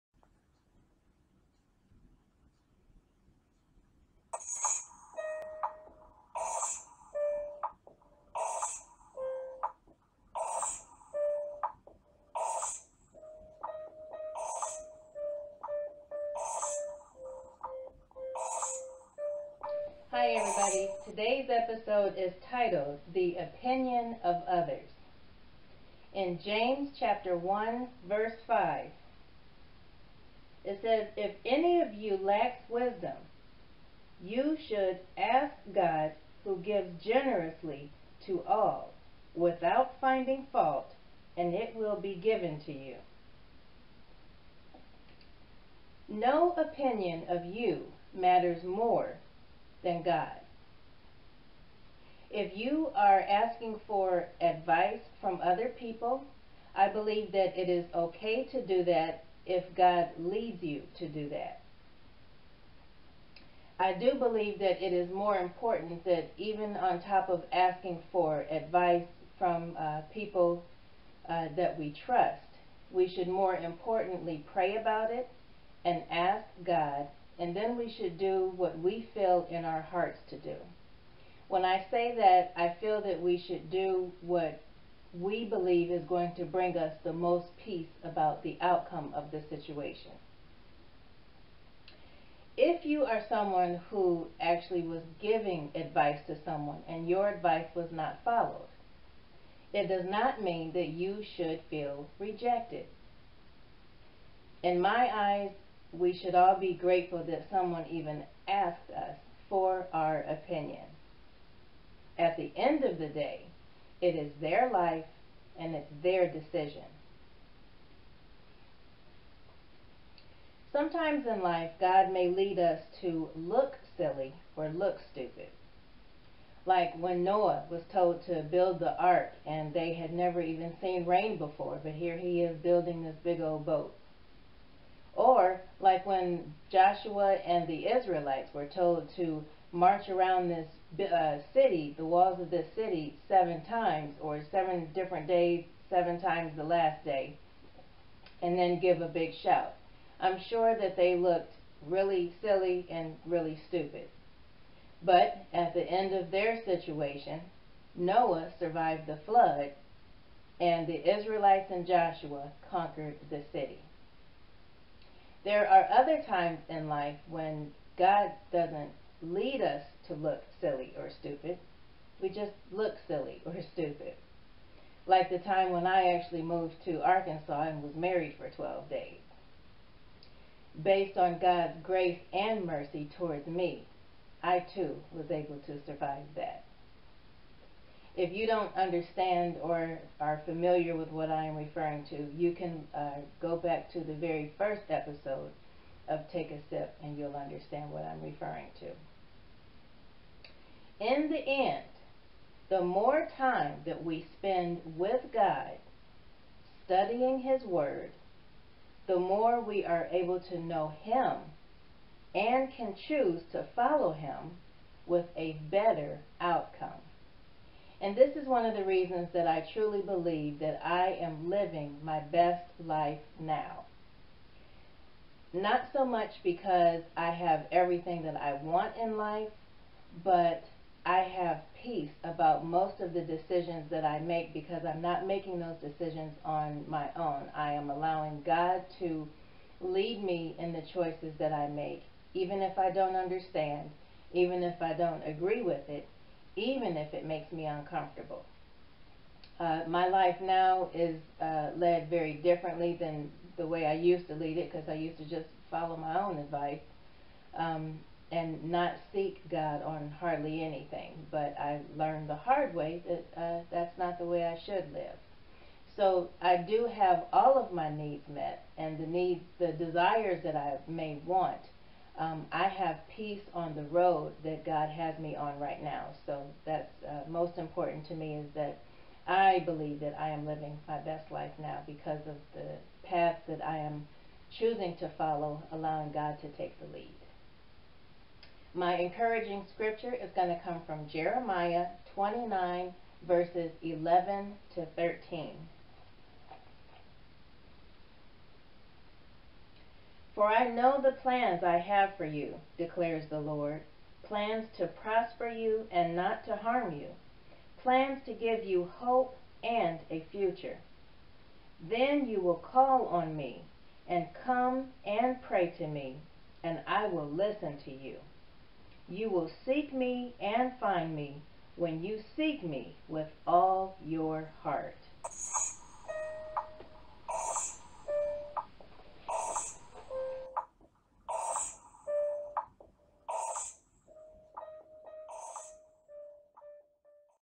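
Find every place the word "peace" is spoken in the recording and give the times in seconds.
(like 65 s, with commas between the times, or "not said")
87 s, 231 s, 273 s.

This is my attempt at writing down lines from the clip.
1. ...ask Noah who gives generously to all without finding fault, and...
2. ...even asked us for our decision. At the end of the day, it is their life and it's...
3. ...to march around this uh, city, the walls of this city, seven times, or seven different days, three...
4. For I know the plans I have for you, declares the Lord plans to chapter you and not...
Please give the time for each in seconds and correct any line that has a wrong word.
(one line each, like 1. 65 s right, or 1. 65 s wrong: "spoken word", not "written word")
1. 35 s wrong: "God", not "Noah"
2. 107 s wrong: "opinion", not "decision"
3. 139 s wrong: "seven", not "three"
4. 300 s wrong: "prosper", not "chapter".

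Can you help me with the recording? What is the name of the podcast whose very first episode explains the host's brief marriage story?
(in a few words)
Take a Sip.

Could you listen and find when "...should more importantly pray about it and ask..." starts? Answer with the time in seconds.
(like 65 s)
73 s.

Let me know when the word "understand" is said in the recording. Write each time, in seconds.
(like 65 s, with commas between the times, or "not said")
188 s, 197 s, 243 s.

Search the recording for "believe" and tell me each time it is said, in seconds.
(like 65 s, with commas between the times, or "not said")
56 s, 64 s, 85 s, 220 s, 279 s.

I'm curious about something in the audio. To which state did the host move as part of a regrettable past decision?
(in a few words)
Arkansas.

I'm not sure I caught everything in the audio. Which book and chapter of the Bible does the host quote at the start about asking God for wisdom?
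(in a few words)
James chapter 1.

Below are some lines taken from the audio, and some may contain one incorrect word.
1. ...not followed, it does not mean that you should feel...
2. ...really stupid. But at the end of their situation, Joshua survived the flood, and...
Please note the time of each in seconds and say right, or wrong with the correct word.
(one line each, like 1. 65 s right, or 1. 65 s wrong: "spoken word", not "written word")
1. 97 s right
2. 153 s wrong: "Noah", not "Joshua".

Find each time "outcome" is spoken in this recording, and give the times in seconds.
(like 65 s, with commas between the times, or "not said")
88 s, 216 s.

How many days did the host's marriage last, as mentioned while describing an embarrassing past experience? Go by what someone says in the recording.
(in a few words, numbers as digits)
12.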